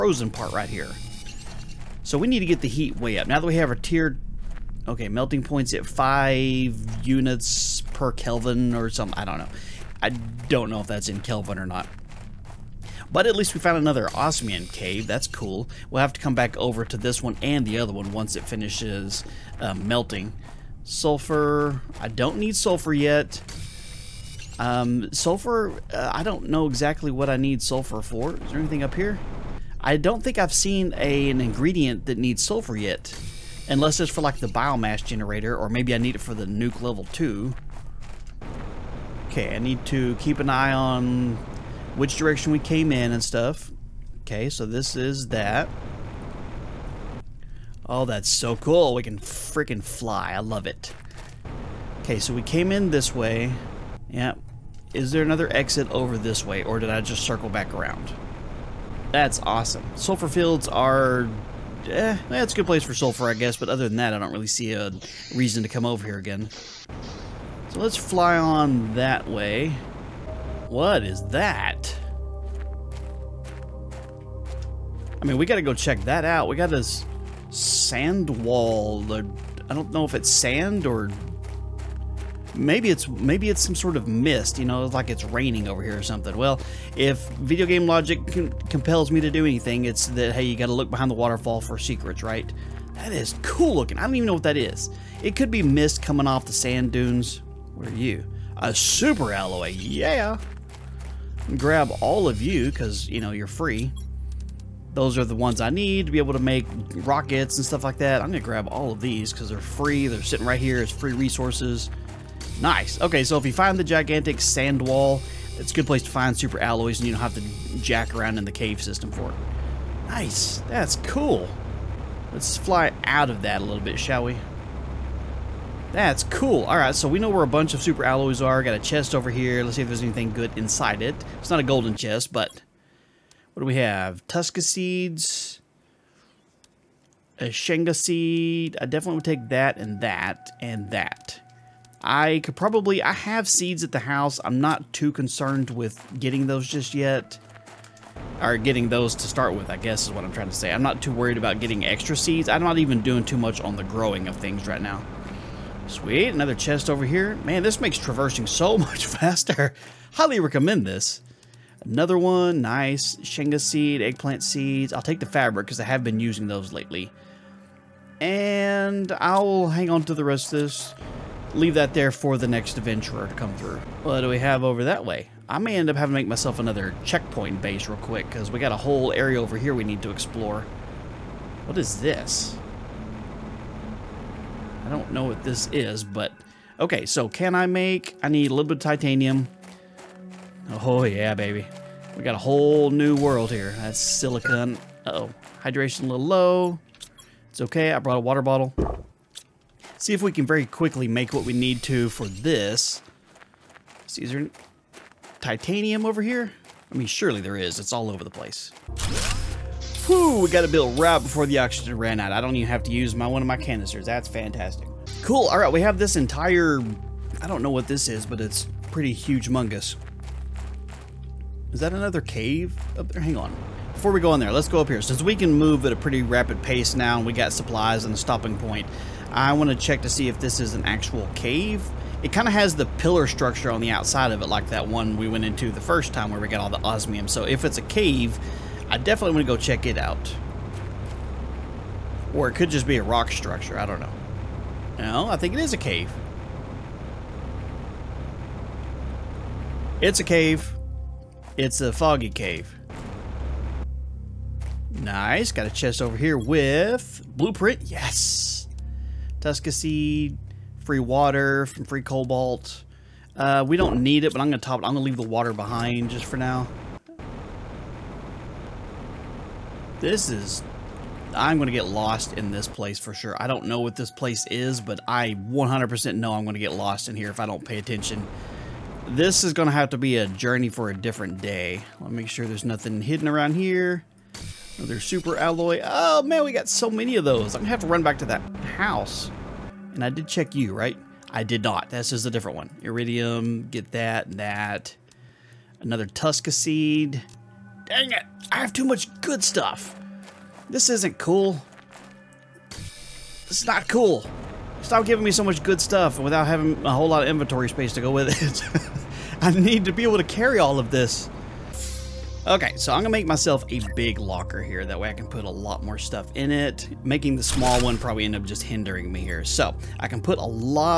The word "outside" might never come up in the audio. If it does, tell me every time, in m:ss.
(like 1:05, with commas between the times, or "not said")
3:53.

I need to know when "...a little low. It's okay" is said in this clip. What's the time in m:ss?
3:16.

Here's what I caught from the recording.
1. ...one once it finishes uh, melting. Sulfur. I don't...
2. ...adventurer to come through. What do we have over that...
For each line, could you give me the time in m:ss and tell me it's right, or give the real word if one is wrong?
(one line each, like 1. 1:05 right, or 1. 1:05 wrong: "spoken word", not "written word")
1. 0:17 right
2. 2:52 right.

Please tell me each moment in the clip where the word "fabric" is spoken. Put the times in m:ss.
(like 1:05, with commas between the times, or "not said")
2:45.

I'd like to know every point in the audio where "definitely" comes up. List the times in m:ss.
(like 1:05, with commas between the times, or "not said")
2:18, 3:58.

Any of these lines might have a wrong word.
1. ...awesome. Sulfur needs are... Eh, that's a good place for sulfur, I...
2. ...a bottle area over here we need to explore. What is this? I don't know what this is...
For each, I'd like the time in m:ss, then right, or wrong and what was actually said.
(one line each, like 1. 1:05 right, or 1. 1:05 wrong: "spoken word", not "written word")
1. 0:59 wrong: "fields", not "needs"
2. 2:58 wrong: "whole", not "bottle".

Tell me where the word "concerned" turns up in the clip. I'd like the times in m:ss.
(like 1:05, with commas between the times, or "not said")
2:25.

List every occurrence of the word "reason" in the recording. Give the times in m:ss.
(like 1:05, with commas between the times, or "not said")
1:05.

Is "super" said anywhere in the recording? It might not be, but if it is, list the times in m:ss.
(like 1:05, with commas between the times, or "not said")
1:38, 1:56, 2:07, 4:44.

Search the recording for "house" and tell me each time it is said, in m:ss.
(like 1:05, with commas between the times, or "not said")
2:23, 4:48.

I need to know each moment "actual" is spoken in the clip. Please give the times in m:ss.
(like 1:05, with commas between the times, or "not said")
3:50.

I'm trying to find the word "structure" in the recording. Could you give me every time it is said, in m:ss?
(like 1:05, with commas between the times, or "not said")
3:53, 4:03.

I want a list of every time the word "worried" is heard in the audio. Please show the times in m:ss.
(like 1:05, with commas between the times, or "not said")
2:31.